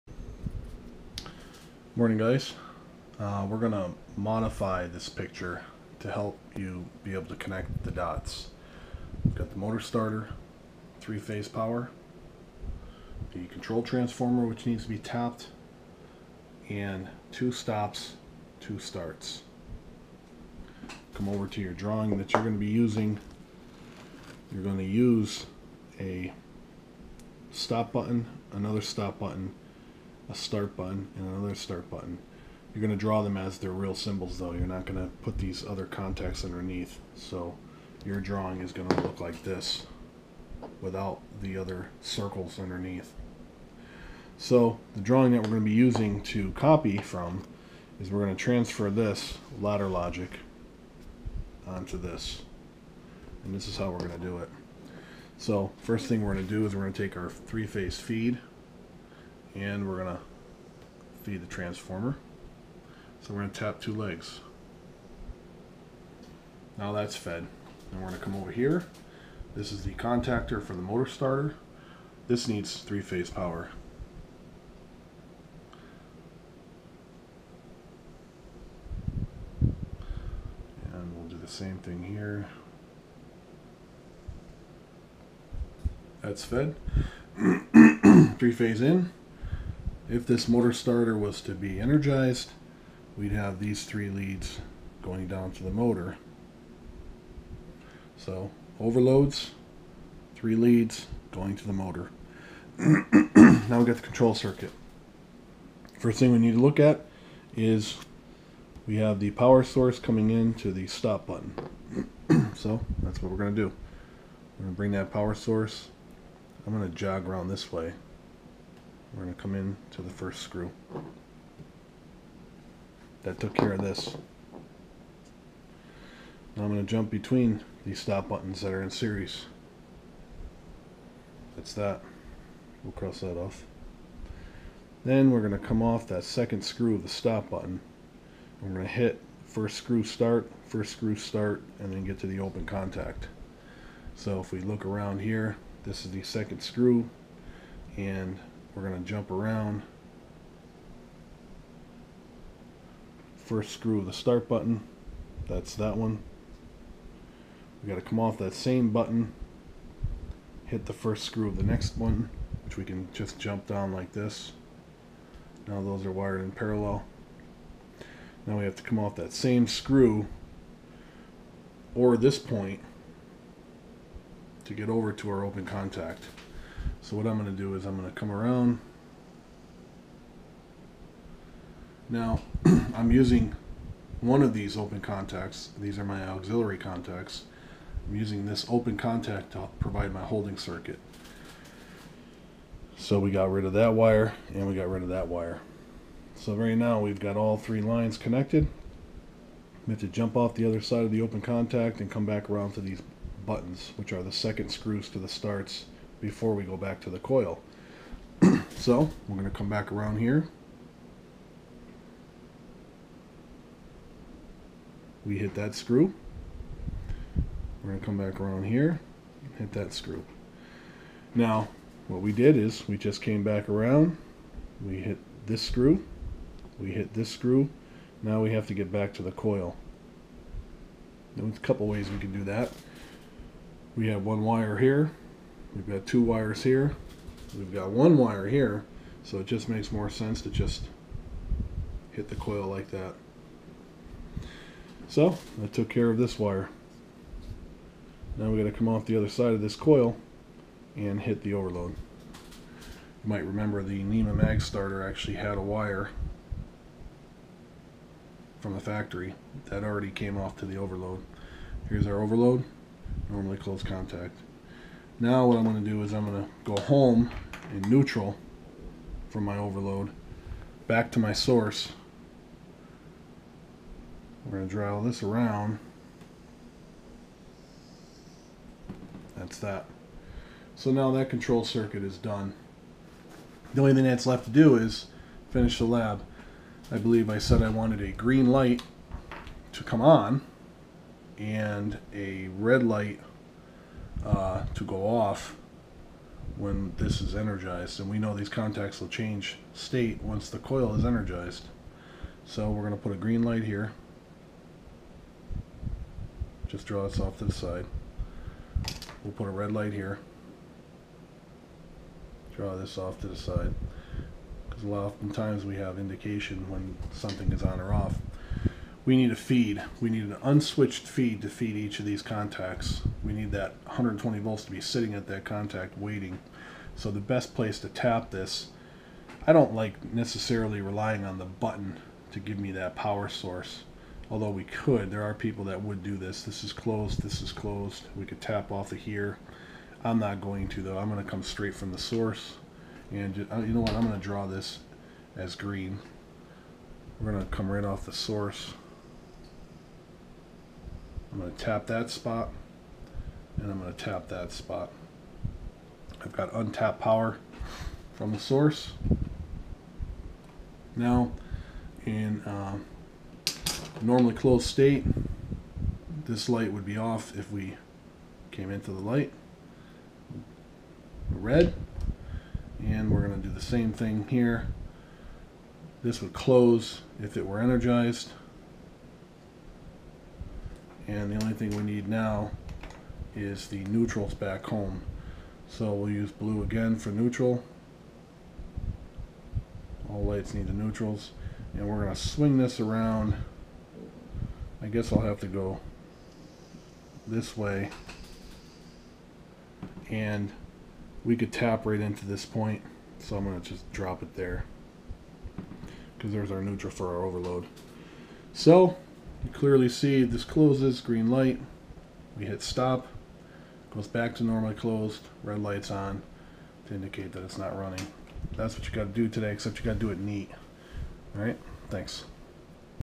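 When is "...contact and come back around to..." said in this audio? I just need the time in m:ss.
3:21.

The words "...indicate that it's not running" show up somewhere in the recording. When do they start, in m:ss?
6:56.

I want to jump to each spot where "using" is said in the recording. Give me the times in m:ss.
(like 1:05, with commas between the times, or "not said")
0:22, 0:45, 3:03, 3:08.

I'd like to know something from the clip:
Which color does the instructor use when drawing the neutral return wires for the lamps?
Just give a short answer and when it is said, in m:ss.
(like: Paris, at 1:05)
Blue, at 6:26.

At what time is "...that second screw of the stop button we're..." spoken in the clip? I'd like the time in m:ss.
2:16.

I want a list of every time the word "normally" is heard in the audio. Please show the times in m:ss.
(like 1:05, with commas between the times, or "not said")
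4:23, 6:04, 6:54.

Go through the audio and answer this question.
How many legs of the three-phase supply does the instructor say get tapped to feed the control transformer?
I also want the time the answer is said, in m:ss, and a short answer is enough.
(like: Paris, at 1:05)
2, at 1:03.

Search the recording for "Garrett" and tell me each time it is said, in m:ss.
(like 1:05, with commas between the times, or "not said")
not said.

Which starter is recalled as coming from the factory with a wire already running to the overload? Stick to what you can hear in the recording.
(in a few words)
NEMA mag starter.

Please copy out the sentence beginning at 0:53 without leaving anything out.
And this is how we're going to do it.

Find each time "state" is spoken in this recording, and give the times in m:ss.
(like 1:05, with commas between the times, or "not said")
4:59, 6:04.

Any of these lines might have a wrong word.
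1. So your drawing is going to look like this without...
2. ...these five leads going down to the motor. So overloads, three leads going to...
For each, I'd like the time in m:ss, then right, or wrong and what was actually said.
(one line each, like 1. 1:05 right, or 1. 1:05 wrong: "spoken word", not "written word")
1. 0:37 right
2. 1:33 wrong: "three", not "five".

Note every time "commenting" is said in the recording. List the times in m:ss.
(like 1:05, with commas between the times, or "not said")
not said.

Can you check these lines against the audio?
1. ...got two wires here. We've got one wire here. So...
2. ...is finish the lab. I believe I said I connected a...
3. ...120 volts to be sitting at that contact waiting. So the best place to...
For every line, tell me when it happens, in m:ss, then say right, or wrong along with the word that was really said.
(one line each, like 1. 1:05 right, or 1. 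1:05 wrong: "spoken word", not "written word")
1. 3:55 right
2. 4:44 wrong: "wanted", not "connected"
3. 5:23 right.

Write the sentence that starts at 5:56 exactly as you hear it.
I've got untapped power from the source.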